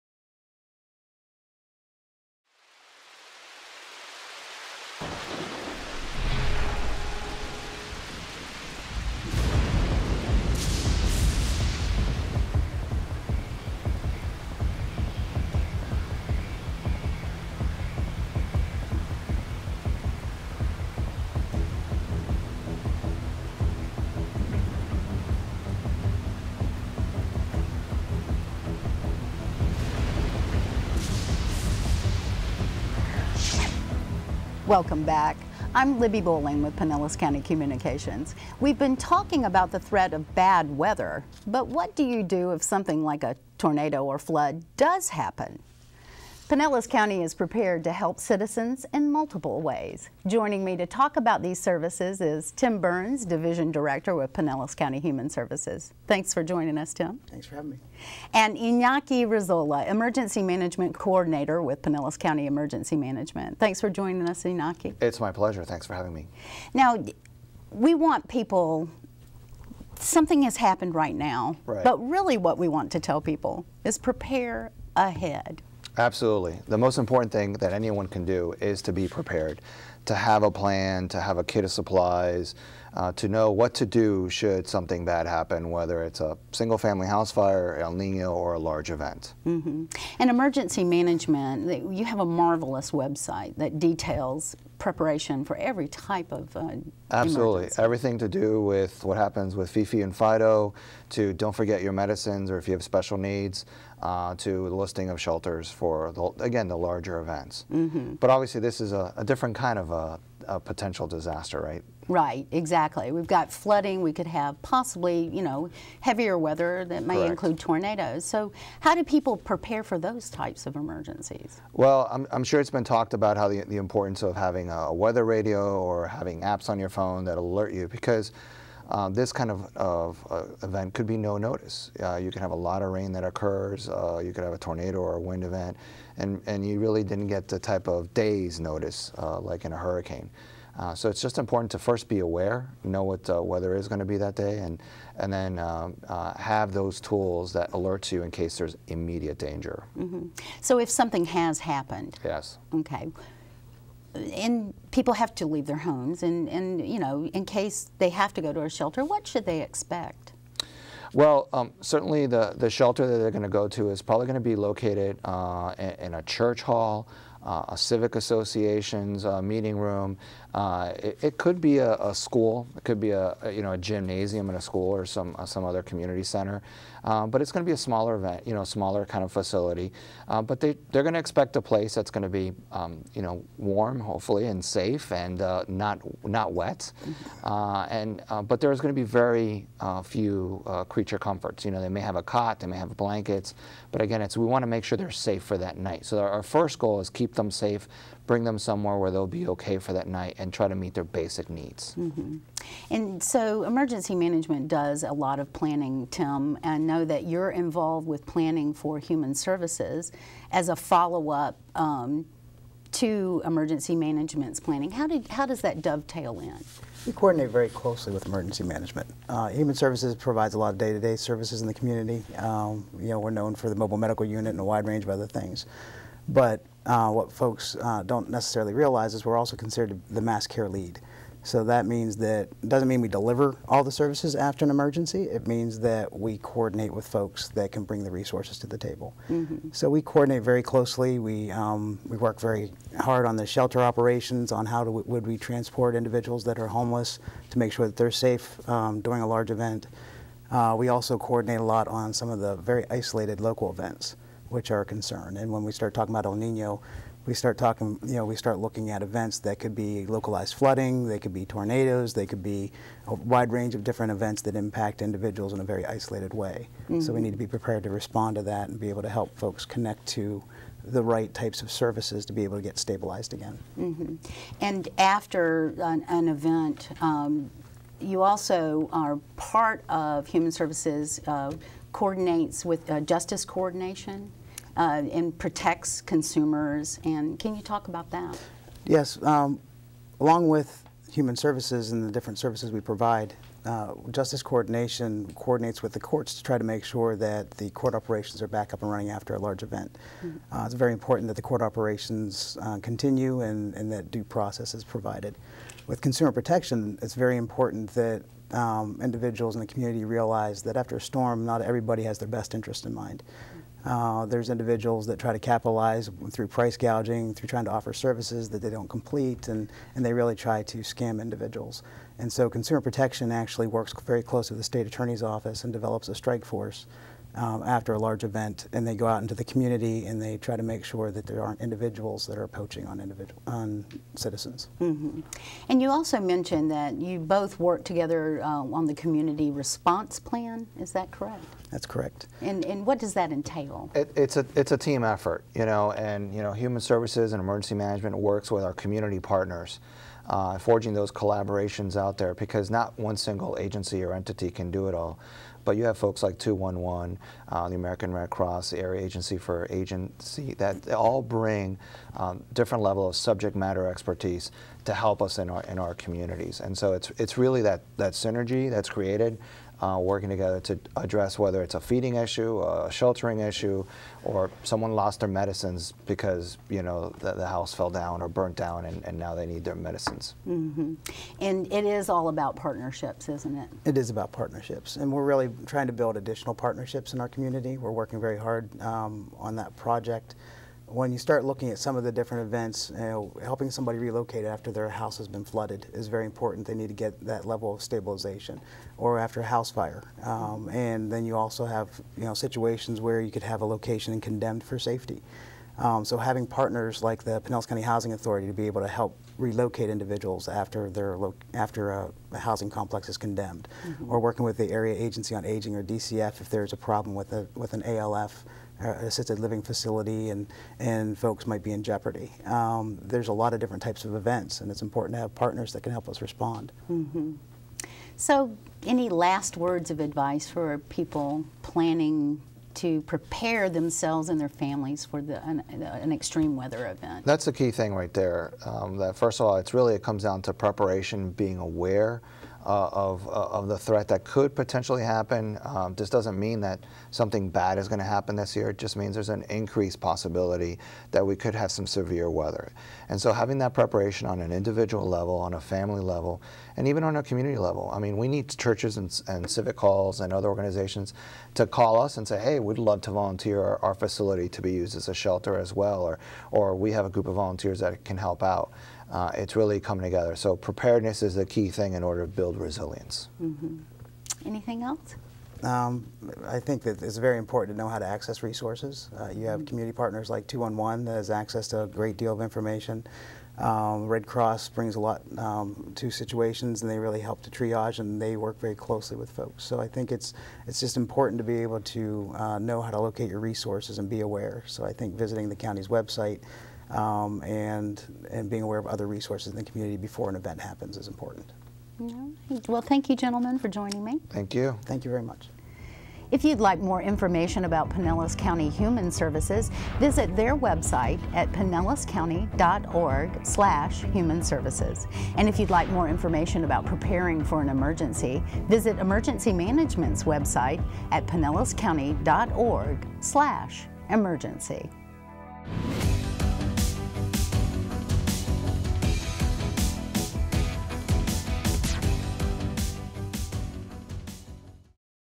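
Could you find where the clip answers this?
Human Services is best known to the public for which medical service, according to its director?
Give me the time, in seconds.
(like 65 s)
223 s.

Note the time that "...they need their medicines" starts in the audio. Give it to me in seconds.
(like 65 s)
379 s.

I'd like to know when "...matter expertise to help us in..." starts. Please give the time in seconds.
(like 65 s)
363 s.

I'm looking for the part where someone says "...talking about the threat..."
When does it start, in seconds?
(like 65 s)
38 s.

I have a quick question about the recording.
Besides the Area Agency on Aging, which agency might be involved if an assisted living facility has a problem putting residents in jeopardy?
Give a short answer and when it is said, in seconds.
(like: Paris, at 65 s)
DCF, at 415 s.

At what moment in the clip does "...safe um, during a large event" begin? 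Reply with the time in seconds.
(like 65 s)
248 s.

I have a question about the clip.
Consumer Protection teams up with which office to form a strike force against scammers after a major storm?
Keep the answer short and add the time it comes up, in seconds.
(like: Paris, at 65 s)
state attorney's office, at 324 s.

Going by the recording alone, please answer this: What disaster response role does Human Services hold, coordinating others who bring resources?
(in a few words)
mass care lead.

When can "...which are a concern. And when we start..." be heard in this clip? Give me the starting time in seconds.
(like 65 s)
254 s.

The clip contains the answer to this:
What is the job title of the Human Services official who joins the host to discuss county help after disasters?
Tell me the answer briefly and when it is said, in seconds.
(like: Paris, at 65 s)
Division Director, at 53 s.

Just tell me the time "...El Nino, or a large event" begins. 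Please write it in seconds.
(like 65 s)
87 s.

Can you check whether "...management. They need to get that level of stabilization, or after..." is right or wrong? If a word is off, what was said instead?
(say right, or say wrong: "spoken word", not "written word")
wrong: "important", not "management".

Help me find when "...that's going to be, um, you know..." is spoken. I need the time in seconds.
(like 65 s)
181 s.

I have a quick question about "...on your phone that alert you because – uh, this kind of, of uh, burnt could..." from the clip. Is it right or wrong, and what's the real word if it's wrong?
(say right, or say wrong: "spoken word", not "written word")
wrong: "event", not "burnt".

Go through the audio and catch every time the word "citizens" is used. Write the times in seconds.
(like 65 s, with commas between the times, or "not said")
48 s, 334 s.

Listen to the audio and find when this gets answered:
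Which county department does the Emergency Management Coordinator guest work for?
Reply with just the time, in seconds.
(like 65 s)
61 s.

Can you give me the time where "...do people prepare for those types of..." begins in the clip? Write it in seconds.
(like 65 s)
118 s.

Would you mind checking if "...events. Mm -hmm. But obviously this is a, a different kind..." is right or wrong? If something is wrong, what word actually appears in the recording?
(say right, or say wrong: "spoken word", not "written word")
right.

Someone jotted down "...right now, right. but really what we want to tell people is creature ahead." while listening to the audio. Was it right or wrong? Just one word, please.
wrong.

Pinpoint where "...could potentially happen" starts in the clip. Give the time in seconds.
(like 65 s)
444 s.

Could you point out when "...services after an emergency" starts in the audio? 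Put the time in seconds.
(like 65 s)
233 s.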